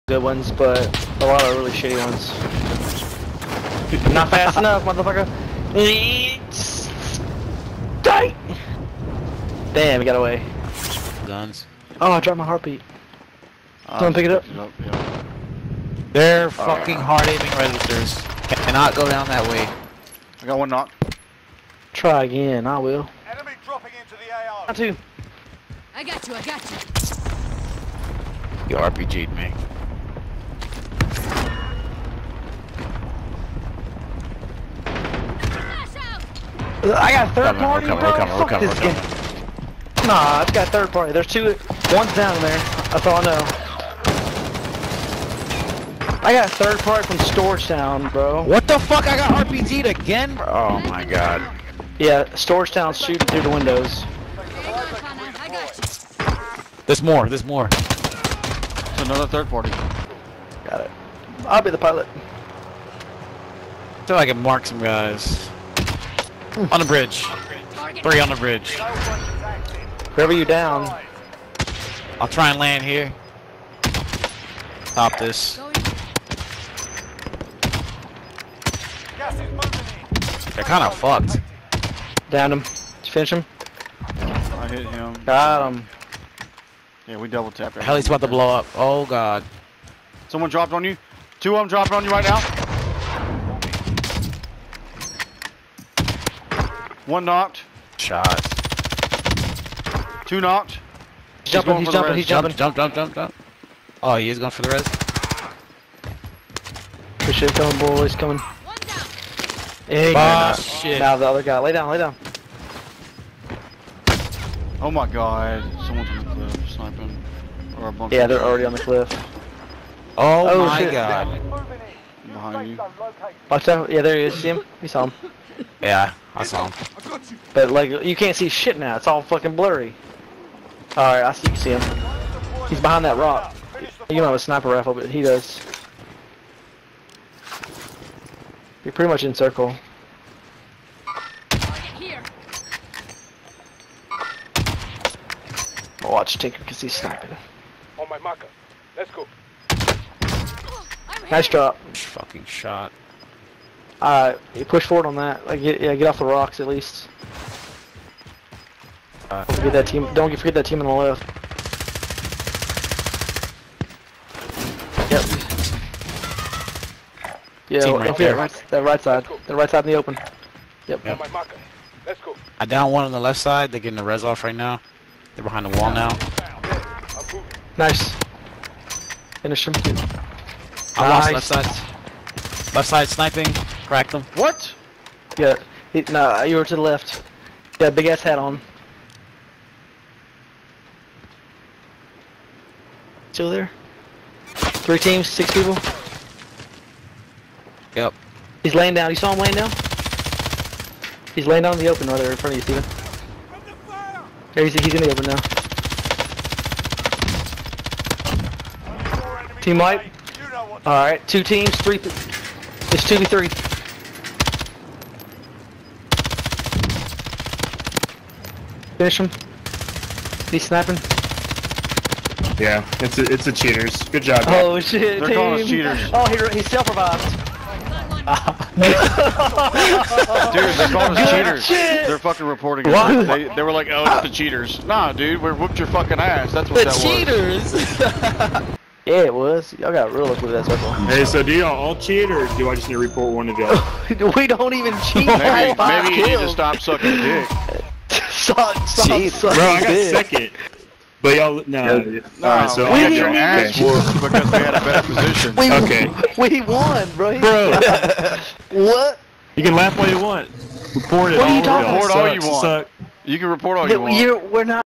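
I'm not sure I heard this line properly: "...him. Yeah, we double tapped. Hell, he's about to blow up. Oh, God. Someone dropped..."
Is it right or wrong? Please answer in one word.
right.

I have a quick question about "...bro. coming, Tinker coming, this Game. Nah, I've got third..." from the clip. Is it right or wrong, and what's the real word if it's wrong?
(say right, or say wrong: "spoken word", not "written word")
wrong: "Fuck", not "Tinker".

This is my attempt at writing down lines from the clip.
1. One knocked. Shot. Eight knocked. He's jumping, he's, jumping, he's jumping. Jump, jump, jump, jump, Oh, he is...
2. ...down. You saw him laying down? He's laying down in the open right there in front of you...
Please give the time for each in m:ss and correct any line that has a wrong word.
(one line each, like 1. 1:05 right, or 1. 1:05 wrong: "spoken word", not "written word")
1. 1:37 wrong: "Two", not "Eight"
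2. 3:18 right.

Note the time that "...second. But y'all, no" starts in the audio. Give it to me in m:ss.
4:10.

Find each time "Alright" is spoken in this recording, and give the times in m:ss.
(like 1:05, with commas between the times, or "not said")
3:30, 4:12.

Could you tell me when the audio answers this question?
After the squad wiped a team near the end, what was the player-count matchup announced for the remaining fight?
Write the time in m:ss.
3:33.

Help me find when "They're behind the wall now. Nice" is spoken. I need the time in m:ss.
2:55.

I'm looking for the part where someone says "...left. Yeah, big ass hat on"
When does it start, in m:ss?
3:06.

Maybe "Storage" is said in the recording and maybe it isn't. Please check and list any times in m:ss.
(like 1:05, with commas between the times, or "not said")
0:47, 0:52.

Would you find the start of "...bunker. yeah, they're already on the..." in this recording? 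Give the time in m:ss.
1:57.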